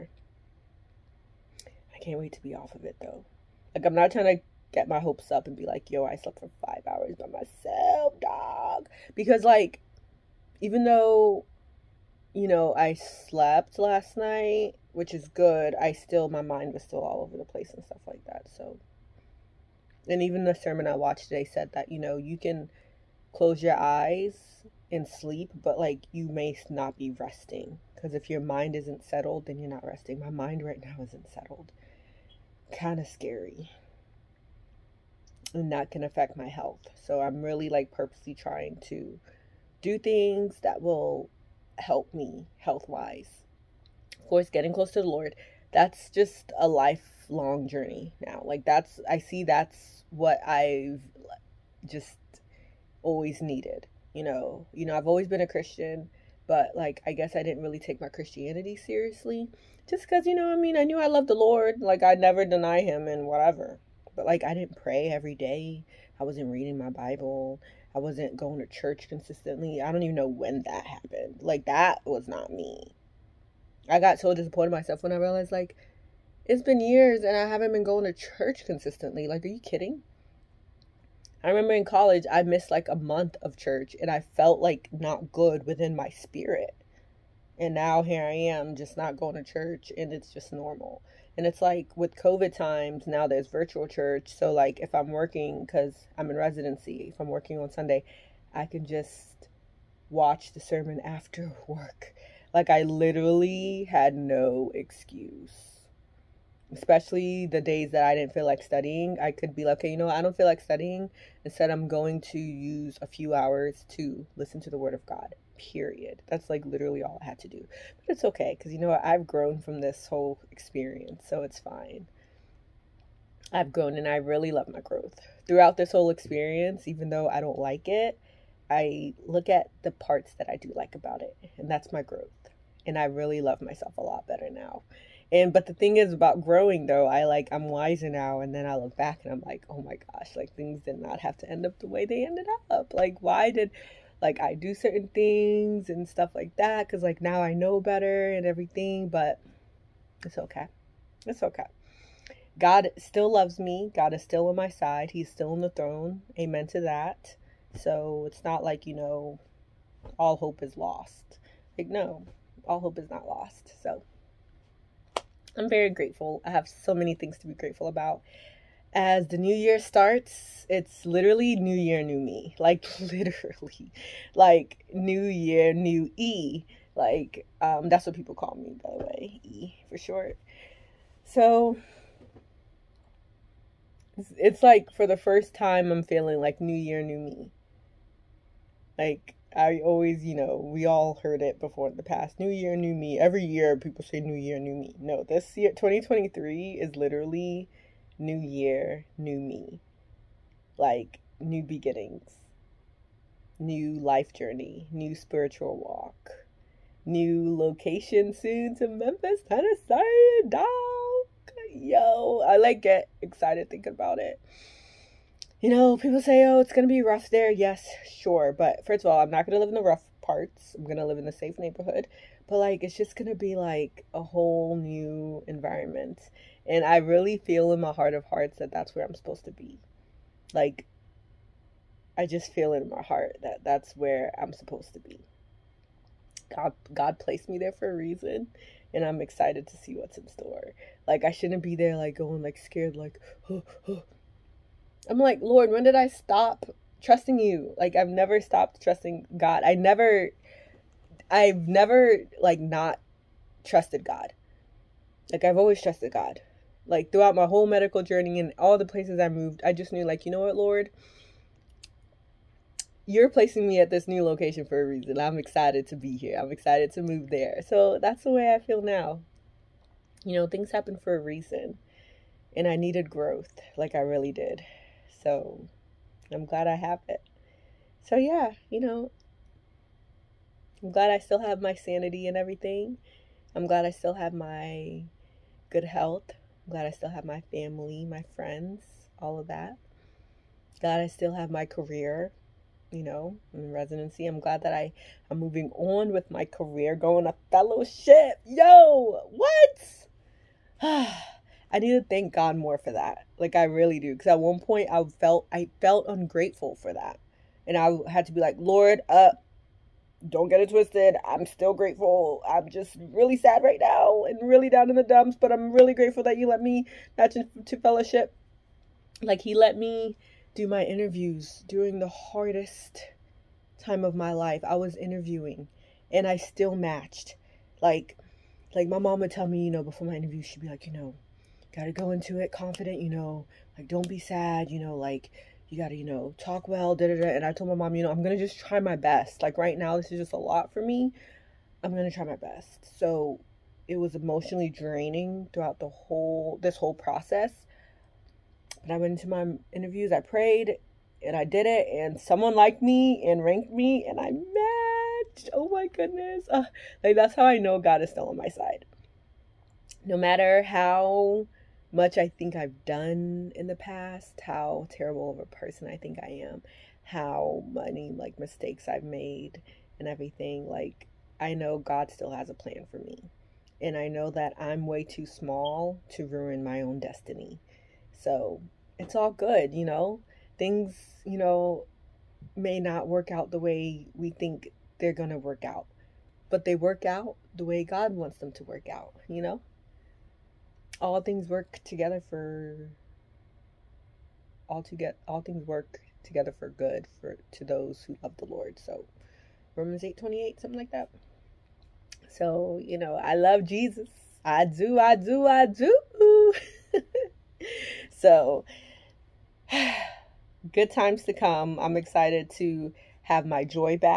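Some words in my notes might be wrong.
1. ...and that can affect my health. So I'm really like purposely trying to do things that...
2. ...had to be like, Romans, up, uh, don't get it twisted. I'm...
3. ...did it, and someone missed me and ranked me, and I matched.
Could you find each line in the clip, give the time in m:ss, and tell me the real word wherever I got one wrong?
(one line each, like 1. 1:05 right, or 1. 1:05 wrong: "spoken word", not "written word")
1. 0:35 right
2. 5:08 wrong: "Lord", not "Romans"
3. 5:51 wrong: "liked", not "missed".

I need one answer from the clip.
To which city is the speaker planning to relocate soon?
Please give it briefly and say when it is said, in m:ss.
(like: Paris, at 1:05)
Memphis, Tennessee, at 3:28.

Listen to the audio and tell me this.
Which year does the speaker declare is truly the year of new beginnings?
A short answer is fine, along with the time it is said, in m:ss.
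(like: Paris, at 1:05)
2023, at 3:15.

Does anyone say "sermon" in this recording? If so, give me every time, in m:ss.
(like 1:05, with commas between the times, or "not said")
0:20, 1:40.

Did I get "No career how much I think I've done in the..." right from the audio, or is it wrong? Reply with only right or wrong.
wrong.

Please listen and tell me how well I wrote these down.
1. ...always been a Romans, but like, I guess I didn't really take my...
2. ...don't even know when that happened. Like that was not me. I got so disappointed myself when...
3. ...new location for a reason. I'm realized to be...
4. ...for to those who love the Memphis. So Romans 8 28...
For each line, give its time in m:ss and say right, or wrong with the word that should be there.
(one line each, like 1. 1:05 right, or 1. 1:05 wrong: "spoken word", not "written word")
1. 0:55 wrong: "Christian", not "Romans"
2. 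1:09 right
3. 4:24 wrong: "excited", not "realized"
4. 6:37 wrong: "Lord", not "Memphis".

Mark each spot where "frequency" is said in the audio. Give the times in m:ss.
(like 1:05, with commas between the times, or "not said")
not said.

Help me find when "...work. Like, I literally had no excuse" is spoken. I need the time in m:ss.
1:41.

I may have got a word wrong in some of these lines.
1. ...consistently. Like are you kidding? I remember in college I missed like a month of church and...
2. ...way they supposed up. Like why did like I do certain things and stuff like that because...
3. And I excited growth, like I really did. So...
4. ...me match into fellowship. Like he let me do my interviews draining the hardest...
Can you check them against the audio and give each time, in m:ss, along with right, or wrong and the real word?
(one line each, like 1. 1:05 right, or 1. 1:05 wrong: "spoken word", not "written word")
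1. 1:18 right
2. 2:21 wrong: "ended", not "supposed"
3. 4:32 wrong: "needed", not "excited"
4. 5:16 wrong: "during", not "draining".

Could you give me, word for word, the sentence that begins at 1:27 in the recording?
And now here I am just not going to church and it's just normal.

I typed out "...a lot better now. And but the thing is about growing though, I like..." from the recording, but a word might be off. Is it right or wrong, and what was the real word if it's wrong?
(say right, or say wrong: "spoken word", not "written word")
right.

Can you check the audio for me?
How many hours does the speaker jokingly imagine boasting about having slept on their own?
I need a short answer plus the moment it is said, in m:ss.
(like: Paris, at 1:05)
5, at 0:06.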